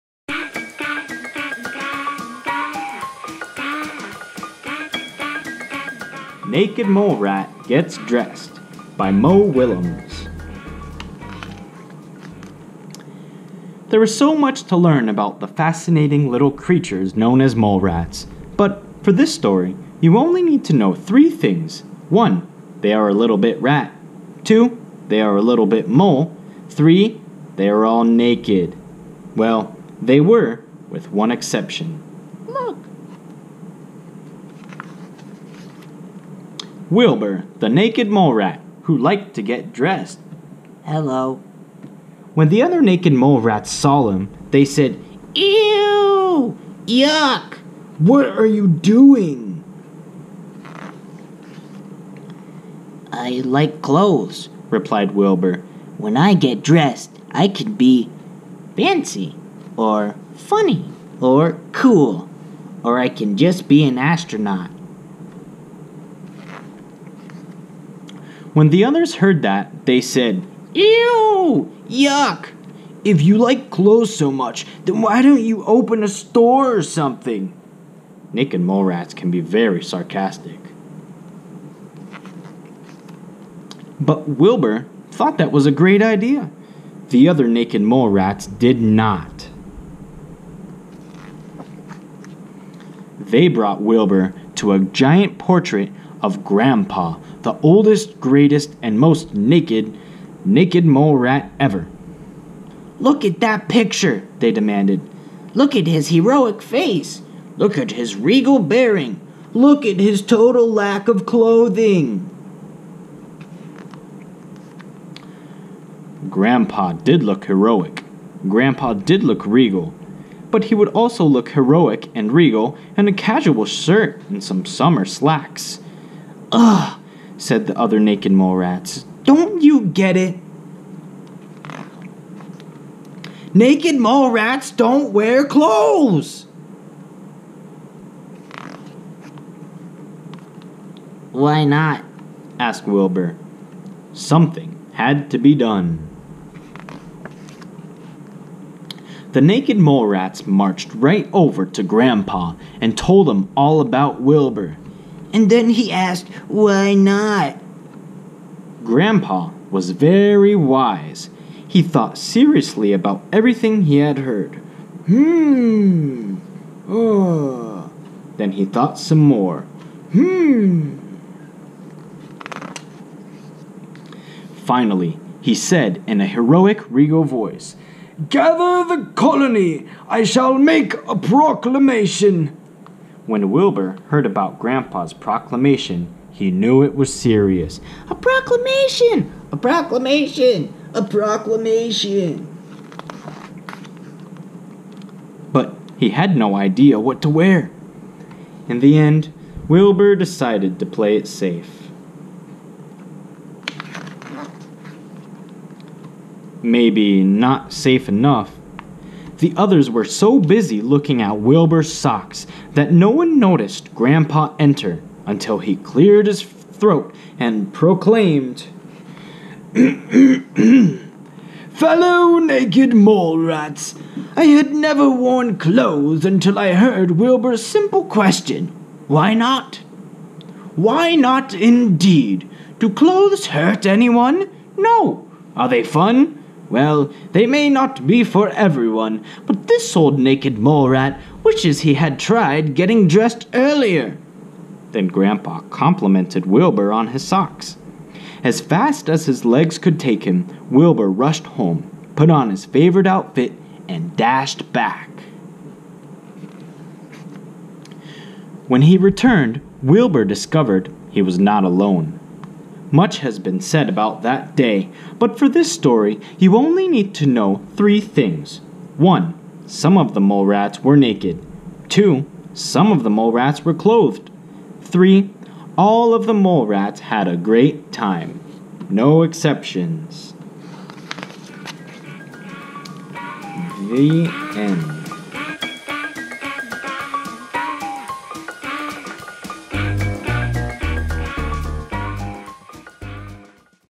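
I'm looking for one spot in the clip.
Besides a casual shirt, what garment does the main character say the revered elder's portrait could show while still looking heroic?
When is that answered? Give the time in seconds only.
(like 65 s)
124 s.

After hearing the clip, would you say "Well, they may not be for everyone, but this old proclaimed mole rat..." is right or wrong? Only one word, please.
wrong.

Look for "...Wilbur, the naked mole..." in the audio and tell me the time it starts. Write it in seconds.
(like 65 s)
36 s.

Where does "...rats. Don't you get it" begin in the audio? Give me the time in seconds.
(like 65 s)
128 s.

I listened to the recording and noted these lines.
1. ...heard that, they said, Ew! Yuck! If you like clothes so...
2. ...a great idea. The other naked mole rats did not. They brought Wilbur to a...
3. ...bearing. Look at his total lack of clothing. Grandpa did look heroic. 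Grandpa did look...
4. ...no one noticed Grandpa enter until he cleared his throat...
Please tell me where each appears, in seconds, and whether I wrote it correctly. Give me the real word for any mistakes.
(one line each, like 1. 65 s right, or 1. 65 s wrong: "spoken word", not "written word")
1. 69 s right
2. 85 s right
3. 108 s right
4. 212 s right.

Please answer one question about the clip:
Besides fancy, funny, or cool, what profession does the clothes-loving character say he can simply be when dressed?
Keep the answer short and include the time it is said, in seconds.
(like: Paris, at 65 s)
An astronaut, at 63 s.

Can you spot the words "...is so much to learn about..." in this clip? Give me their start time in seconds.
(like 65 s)
14 s.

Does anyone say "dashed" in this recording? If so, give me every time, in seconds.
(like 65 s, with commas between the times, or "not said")
254 s.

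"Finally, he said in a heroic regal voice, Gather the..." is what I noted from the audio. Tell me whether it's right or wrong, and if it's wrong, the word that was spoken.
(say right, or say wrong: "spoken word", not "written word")
right.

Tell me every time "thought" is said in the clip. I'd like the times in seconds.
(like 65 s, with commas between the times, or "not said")
85 s, 161 s, 168 s.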